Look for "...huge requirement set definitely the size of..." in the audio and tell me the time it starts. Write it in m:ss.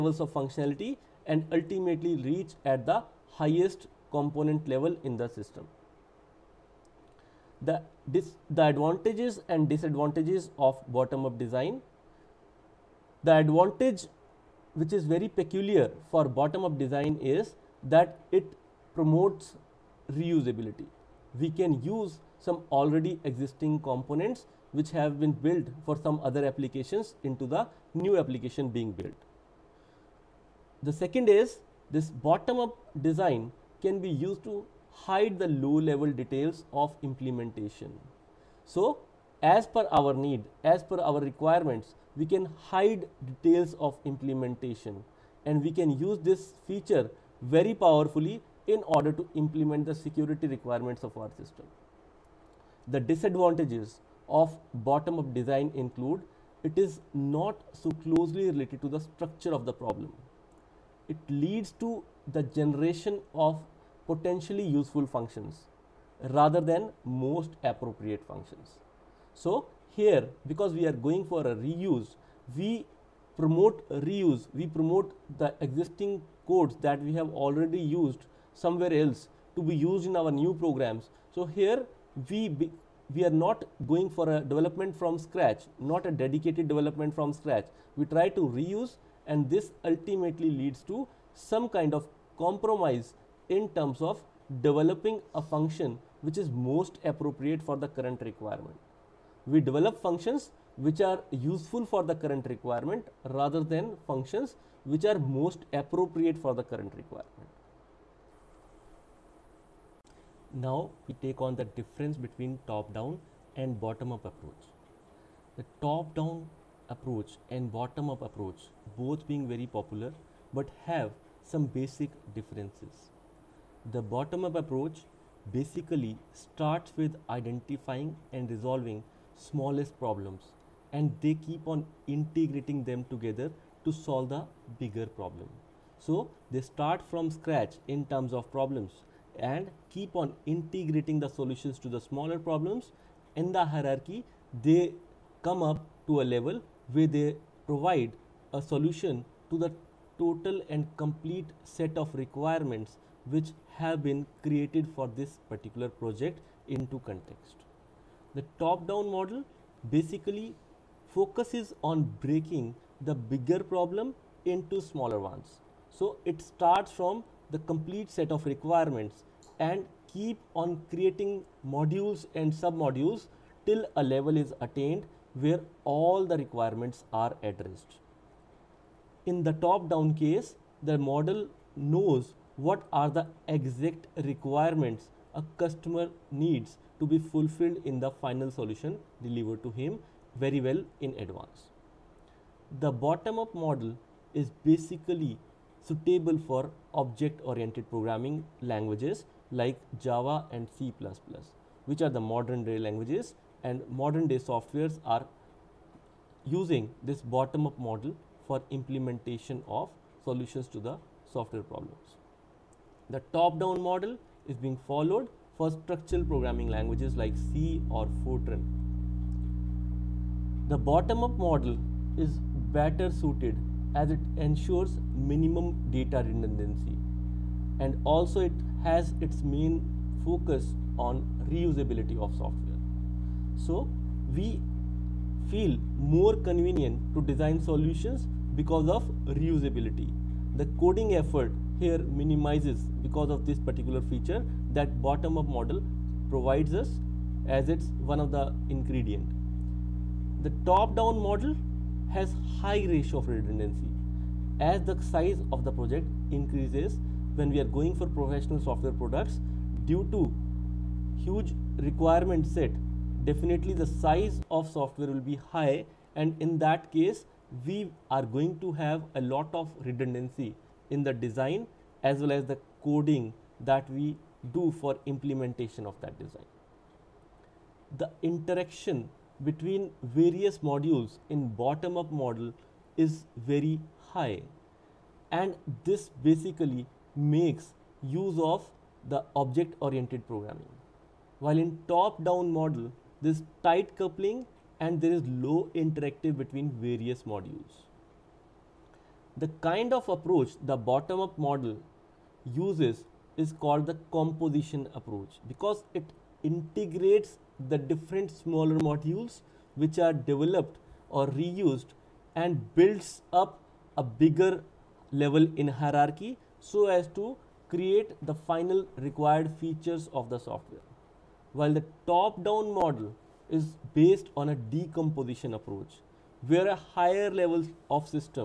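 4:21.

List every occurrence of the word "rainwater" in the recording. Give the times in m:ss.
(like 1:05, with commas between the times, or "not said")
not said.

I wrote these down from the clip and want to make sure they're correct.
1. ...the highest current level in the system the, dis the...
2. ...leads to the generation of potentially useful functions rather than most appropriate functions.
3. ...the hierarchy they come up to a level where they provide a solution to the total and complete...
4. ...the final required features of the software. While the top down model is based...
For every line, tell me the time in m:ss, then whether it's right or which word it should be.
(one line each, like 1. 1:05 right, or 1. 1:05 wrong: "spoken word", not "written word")
1. 0:02 wrong: "component", not "current"
2. 1:01 right
3. 2:23 right
4. 5:18 right.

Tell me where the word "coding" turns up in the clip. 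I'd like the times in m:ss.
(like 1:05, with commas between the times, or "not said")
4:00, 4:32.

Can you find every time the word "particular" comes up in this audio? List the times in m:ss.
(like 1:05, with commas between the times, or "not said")
2:35, 4:03.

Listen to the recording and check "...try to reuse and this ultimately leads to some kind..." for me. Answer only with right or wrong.
right.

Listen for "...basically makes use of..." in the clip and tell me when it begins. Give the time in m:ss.
4:46.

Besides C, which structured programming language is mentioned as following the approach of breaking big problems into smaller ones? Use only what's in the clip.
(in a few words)
Fortran.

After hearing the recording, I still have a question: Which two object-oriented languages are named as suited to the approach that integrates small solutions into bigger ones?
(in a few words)
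Java and C++.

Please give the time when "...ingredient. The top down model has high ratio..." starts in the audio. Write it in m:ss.
4:08.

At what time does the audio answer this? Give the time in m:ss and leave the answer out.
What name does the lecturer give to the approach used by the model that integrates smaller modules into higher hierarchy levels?
5:04.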